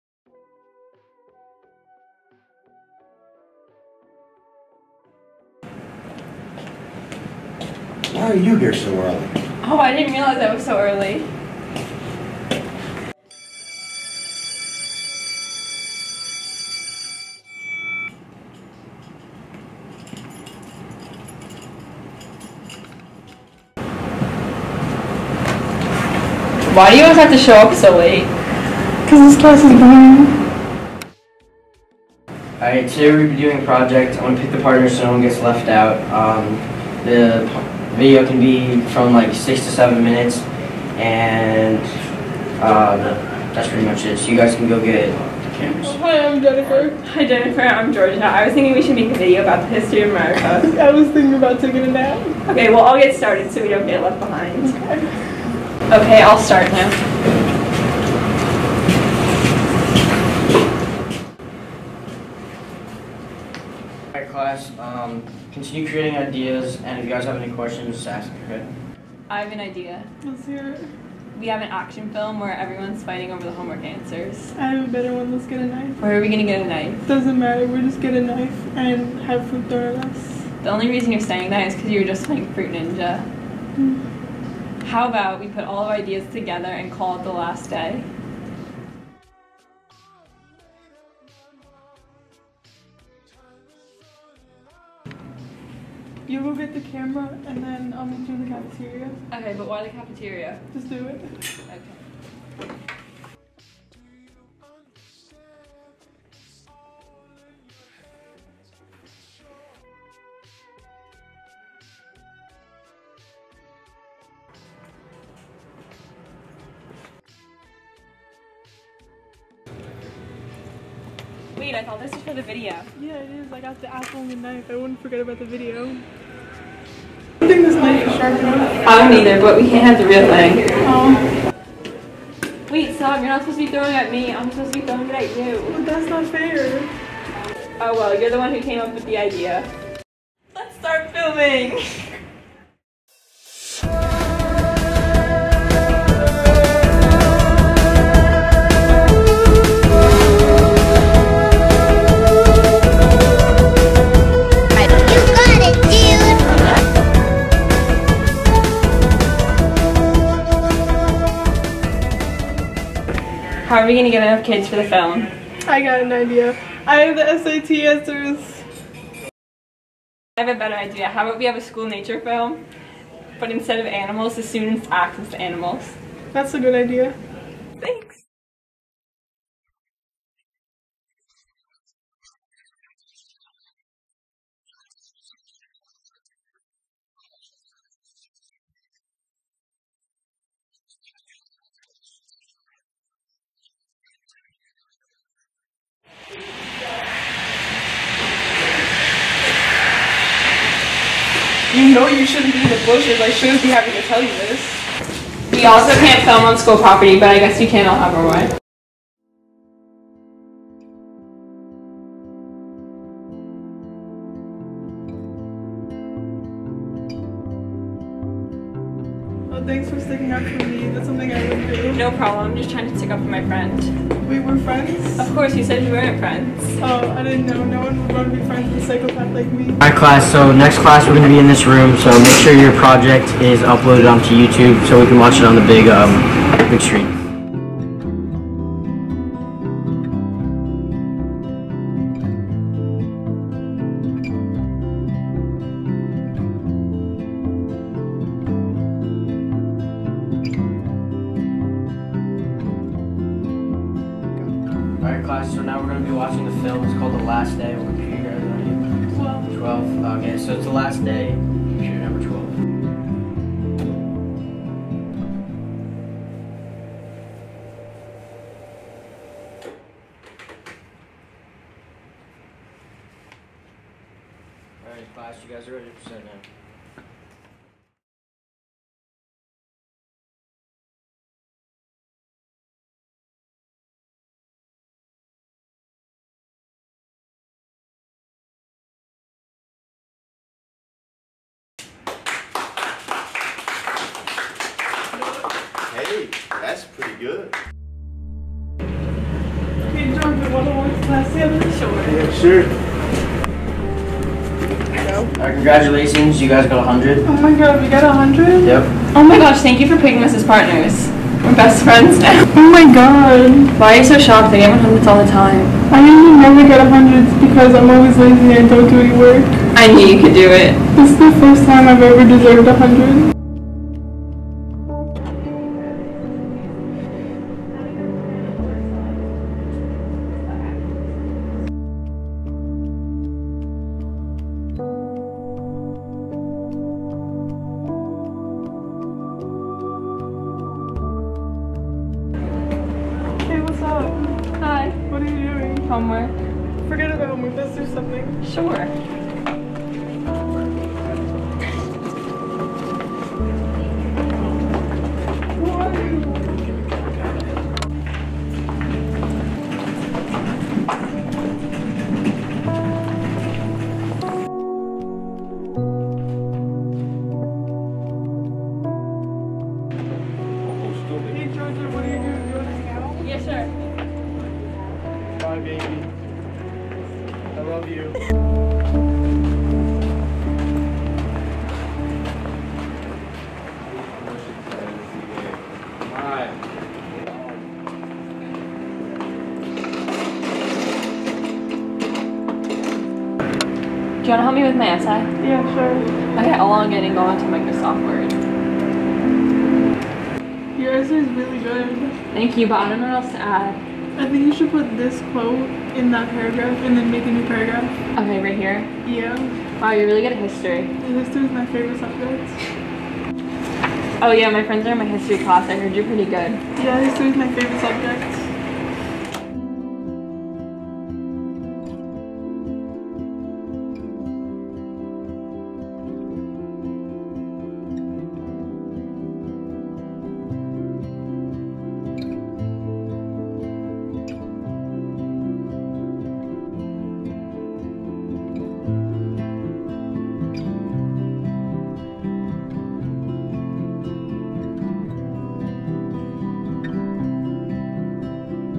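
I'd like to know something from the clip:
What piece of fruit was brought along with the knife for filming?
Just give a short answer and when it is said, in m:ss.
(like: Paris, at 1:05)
apple, at 2:03.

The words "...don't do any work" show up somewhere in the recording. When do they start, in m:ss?
5:18.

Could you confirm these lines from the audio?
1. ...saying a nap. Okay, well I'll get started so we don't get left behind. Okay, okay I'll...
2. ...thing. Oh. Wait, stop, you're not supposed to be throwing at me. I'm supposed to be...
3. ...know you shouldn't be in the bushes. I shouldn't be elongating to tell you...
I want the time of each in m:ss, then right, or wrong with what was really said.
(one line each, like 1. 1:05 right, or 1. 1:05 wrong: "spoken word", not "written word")
1. 0:51 wrong: "taking", not "saying"
2. 2:10 right
3. 3:21 wrong: "having", not "elongating".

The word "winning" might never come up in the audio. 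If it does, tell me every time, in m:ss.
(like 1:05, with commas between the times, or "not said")
not said.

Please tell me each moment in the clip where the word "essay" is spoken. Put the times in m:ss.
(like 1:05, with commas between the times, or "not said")
6:34, 6:40.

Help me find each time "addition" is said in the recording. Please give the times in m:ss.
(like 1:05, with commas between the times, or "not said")
not said.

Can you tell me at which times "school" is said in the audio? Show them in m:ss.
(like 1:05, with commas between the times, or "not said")
2:51, 3:26.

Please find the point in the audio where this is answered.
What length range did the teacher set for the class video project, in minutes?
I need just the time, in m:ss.
0:39.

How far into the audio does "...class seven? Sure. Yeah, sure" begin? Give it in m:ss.
5:01.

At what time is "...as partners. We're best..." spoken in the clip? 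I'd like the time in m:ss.
5:10.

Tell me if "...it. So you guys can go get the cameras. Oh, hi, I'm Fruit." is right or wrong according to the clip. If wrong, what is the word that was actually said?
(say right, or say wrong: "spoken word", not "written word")
wrong: "Jennifer", not "Fruit".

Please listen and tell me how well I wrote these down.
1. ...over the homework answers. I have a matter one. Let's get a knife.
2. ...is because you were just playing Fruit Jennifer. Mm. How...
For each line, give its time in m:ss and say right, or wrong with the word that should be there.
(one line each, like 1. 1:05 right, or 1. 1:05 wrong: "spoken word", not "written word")
1. 1:13 wrong: "better", not "matter"
2. 1:21 wrong: "Ninja", not "Jennifer".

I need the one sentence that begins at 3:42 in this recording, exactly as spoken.
I'm just trying to stick up for my friend.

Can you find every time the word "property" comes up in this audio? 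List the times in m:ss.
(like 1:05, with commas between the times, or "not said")
3:26.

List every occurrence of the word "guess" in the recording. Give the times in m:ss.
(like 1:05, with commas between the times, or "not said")
3:27.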